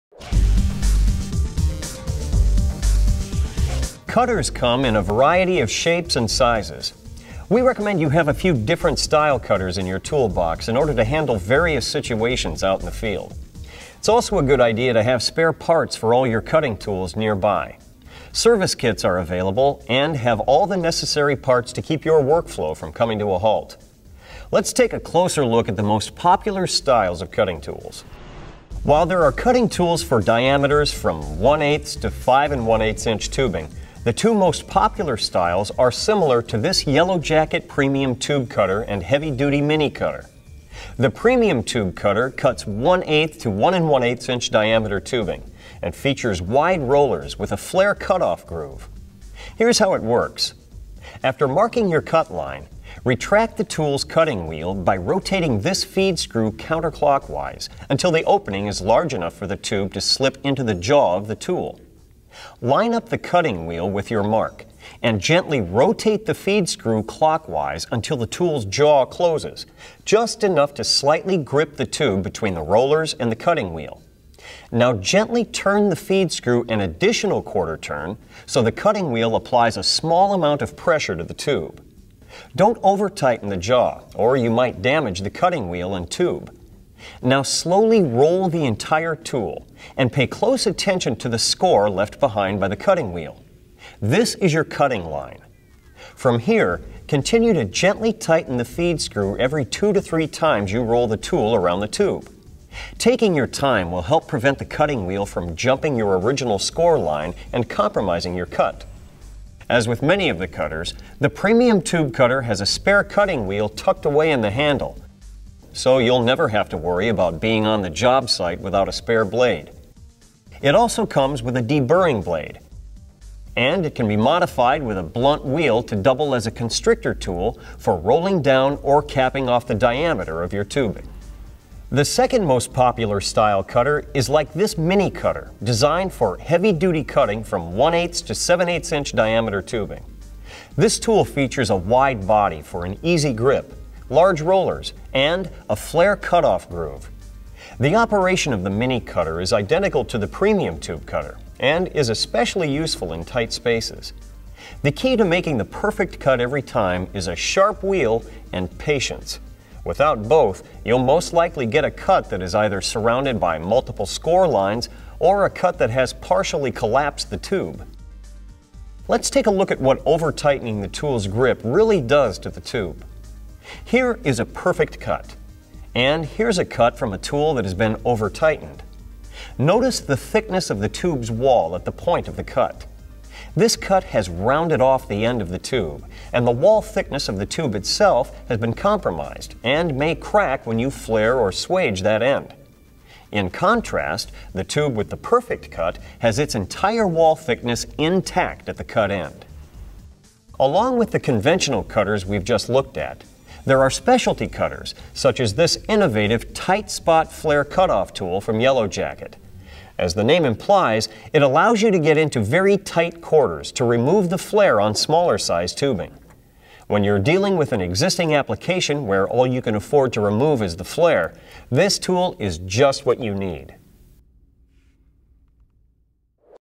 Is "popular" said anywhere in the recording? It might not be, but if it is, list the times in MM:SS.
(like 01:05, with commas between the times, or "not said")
00:26, 00:34, 02:12.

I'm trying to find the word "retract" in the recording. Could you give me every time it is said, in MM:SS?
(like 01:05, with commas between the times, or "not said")
00:53.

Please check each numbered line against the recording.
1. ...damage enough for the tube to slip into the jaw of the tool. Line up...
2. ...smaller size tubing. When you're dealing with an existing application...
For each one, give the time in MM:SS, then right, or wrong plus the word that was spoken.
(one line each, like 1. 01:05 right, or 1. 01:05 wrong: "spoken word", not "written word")
1. 00:58 wrong: "large", not "damage"
2. 03:34 right.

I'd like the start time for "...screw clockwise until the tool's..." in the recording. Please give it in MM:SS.
01:06.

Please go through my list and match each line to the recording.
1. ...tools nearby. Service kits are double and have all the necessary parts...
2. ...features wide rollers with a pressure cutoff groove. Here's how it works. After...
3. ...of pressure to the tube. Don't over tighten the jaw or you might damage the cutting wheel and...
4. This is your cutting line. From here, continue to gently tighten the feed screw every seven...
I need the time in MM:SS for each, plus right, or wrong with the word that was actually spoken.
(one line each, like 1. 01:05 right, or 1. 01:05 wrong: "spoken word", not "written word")
1. 00:16 wrong: "available", not "double"
2. 00:45 wrong: "flare", not "pressure"
3. 01:20 right
4. 01:34 wrong: "two", not "seven".